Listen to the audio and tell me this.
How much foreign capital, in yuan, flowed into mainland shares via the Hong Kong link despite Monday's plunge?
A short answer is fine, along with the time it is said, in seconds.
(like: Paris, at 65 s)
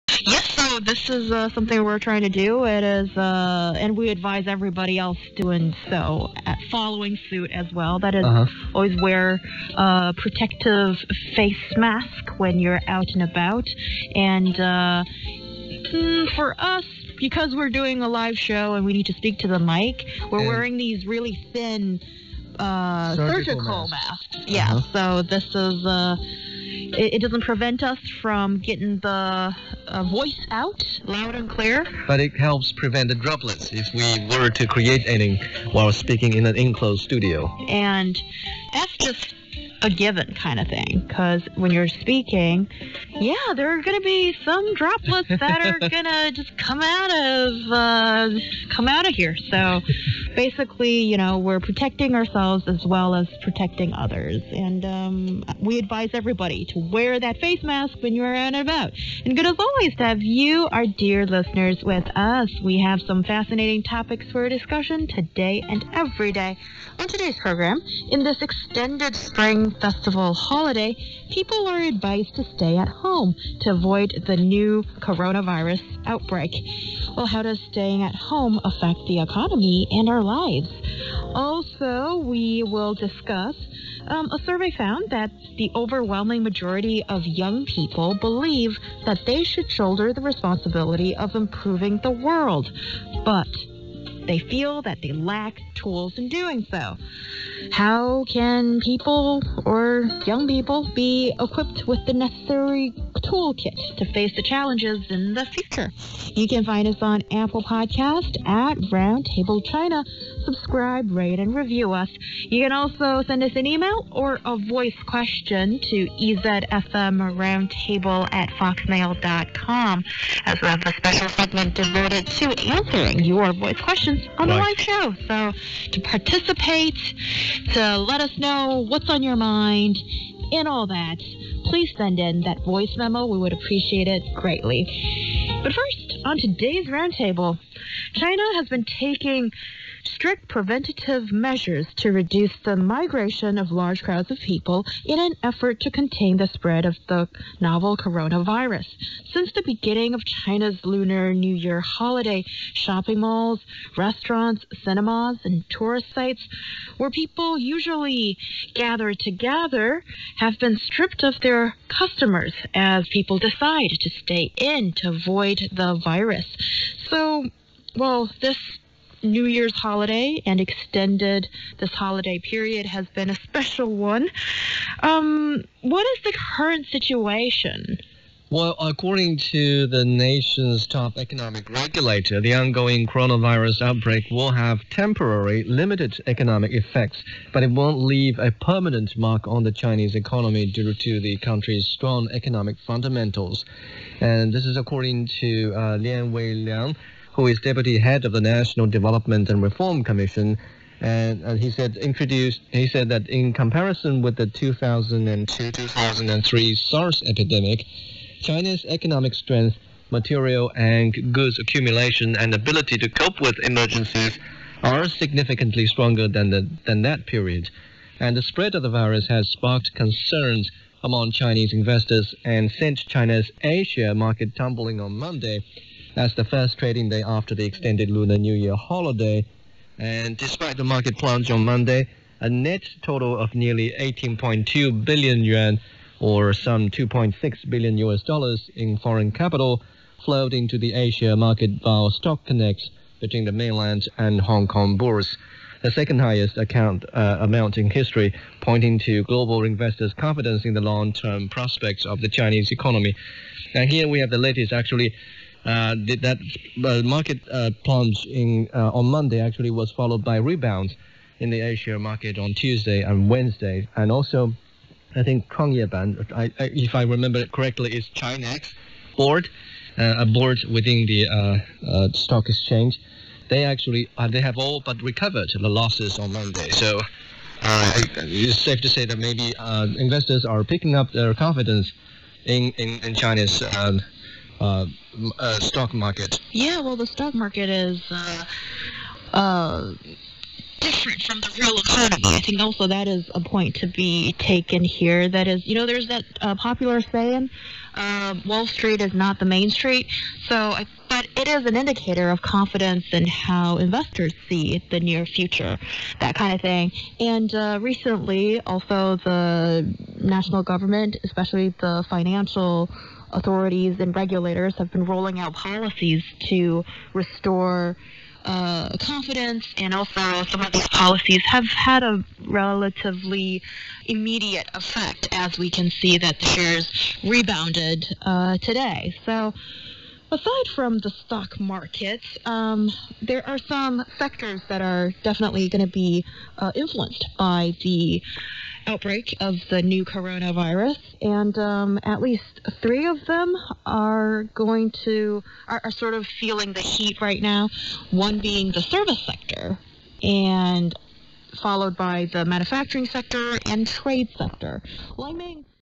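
18.2 billion yuan, at 233 s.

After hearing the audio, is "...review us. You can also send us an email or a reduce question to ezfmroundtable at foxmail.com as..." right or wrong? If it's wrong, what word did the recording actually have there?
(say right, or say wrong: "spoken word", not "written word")
wrong: "voice", not "reduce".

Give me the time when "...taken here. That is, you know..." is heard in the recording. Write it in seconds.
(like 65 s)
294 s.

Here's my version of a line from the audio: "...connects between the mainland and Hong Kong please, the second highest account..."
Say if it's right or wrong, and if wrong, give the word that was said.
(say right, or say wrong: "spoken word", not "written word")
wrong: "bourse", not "please".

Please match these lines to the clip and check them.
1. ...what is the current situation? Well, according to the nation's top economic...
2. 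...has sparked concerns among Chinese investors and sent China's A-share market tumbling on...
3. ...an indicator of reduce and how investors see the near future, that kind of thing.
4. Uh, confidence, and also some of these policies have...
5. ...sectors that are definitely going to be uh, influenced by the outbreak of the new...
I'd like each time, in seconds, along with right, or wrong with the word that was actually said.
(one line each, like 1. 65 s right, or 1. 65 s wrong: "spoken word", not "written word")
1. 175 s right
2. 219 s right
3. 301 s wrong: "confidence", not "reduce"
4. 318 s right
5. 334 s right.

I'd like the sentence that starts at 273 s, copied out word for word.
They actually they have all but recovered the losses on Monday.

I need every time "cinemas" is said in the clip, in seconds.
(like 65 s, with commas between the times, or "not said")
154 s.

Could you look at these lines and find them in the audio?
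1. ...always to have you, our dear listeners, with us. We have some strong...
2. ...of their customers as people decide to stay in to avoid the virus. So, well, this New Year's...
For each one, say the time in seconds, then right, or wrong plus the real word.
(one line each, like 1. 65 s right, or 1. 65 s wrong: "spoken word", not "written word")
1. 59 s wrong: "fascinating", not "strong"
2. 161 s right.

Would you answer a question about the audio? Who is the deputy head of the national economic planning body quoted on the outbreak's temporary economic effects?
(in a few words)
Lian Weiliang.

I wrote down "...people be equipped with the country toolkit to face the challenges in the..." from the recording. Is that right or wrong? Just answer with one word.
wrong.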